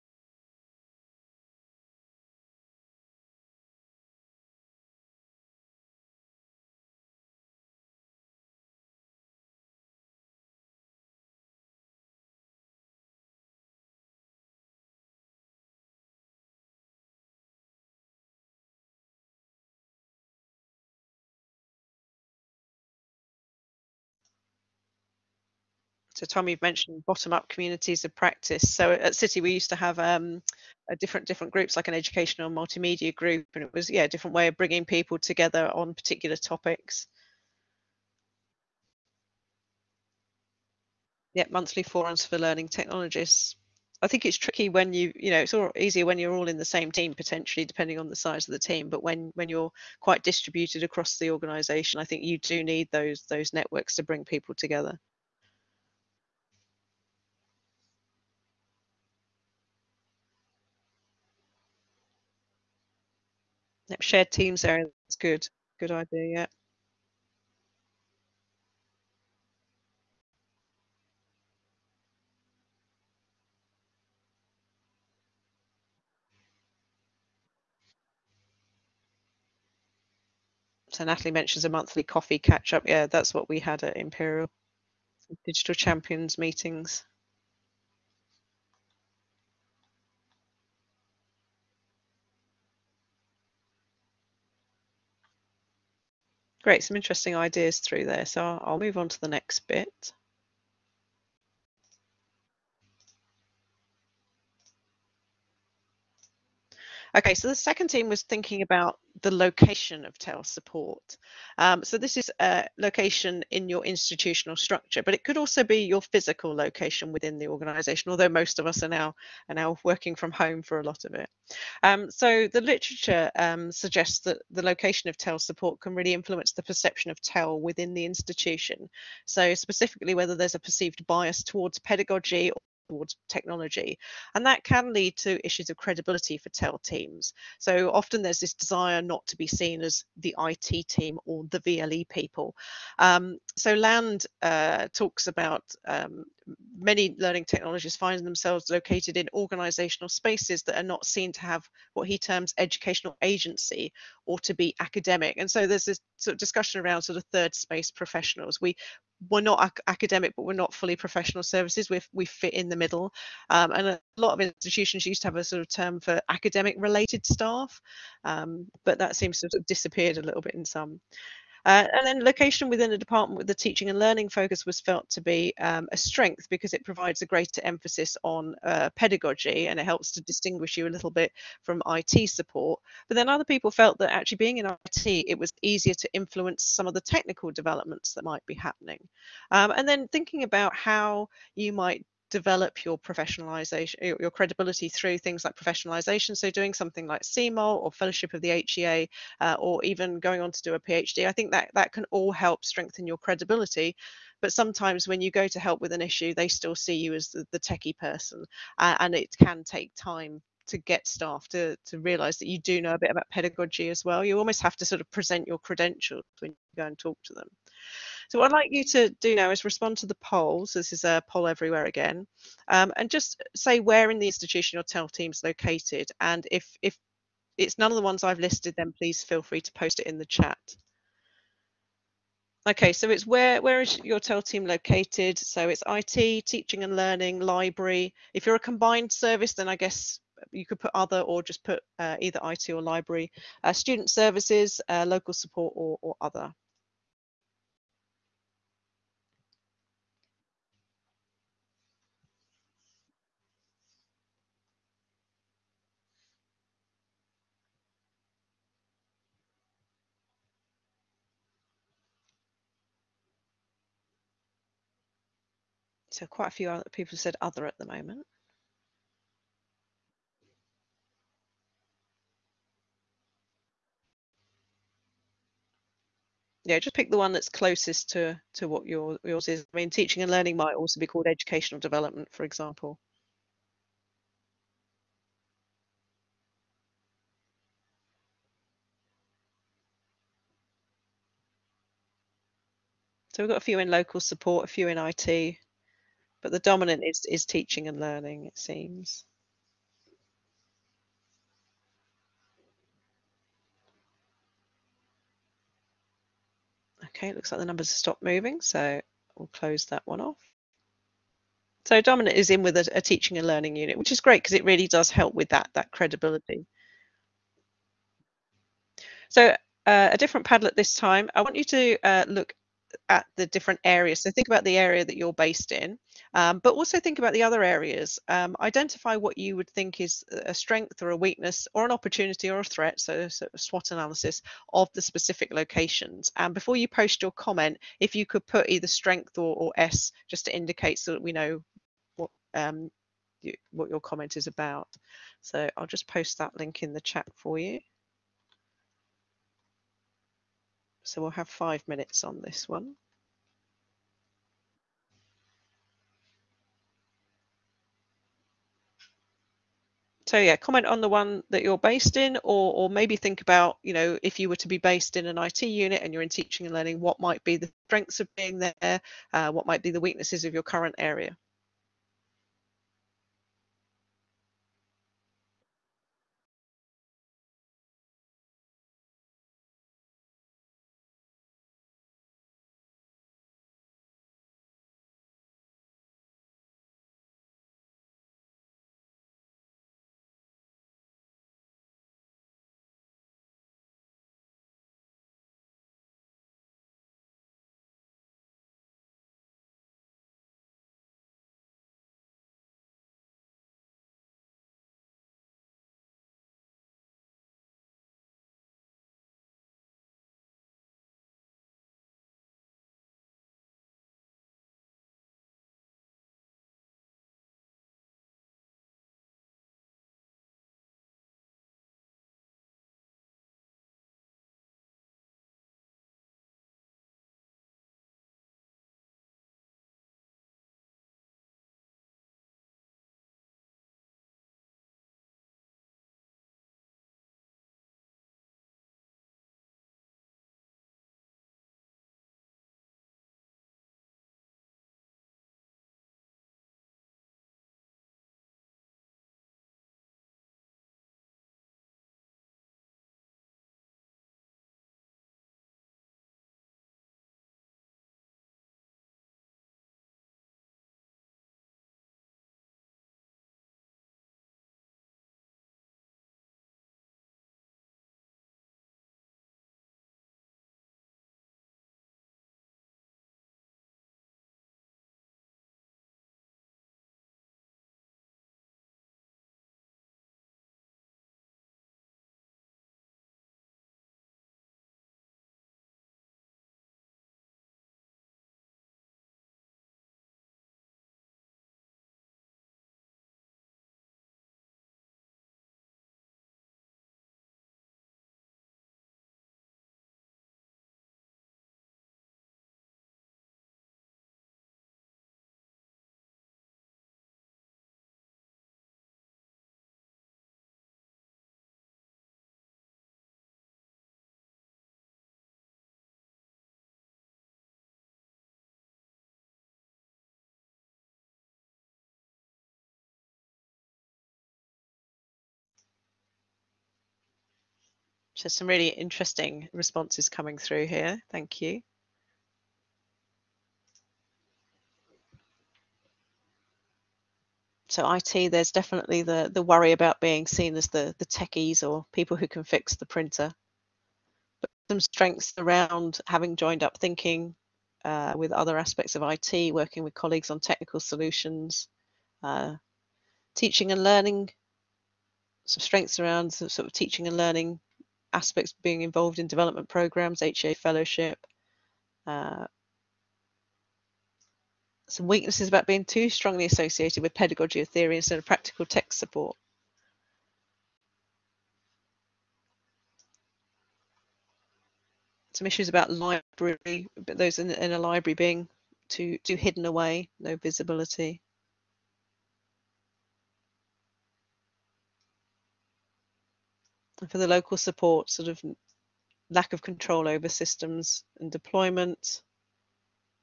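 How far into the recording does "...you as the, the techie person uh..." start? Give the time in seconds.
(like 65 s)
206 s.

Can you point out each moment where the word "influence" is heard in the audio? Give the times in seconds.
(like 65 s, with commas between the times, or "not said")
126 s, 186 s.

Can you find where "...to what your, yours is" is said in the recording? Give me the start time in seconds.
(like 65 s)
278 s.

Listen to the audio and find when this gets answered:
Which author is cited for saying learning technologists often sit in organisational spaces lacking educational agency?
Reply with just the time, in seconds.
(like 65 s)
143 s.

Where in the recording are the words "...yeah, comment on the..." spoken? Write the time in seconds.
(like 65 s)
360 s.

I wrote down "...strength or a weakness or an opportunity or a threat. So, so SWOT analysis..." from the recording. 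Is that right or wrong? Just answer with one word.
right.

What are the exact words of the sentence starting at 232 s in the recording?
Okay, so it's where where is your TEL team located?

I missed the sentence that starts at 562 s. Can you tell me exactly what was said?
Uh, some weaknesses about being too strongly associated with pedagogy or theory instead of practical text support.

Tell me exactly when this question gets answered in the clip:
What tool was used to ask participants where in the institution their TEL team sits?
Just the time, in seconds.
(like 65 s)
221 s.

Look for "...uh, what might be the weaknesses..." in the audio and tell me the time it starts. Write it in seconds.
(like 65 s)
369 s.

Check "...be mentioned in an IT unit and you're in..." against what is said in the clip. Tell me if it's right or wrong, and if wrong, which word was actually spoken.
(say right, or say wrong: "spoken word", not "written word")
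wrong: "based", not "mentioned".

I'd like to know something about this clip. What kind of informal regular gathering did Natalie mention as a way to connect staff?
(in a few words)
Monthly coffee catch up.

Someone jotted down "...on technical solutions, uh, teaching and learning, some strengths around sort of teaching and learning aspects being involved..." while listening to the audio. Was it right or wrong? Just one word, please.
right.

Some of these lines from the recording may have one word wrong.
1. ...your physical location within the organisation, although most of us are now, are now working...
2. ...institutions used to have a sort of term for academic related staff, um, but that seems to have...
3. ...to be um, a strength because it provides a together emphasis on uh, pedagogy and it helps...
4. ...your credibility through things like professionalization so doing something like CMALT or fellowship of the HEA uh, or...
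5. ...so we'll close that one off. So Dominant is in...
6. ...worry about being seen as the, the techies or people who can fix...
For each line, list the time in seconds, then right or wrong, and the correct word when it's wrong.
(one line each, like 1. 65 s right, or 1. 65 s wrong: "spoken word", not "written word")
1. 115 s right
2. 164 s right
3. 175 s wrong: "greater", not "together"
4. 194 s right
5. 308 s right
6. 539 s right.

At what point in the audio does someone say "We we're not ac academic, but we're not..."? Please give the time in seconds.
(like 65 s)
158 s.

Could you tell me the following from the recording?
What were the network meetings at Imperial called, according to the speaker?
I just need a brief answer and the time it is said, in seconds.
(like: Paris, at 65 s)
Digital Champions meetings, at 85 s.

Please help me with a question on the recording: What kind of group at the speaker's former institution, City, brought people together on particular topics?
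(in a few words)
Educational multimedia group.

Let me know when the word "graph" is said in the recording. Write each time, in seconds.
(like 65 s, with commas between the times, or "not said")
not said.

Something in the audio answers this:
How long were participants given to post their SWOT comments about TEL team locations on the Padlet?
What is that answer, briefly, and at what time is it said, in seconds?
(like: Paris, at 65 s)
5 minutes, at 351 s.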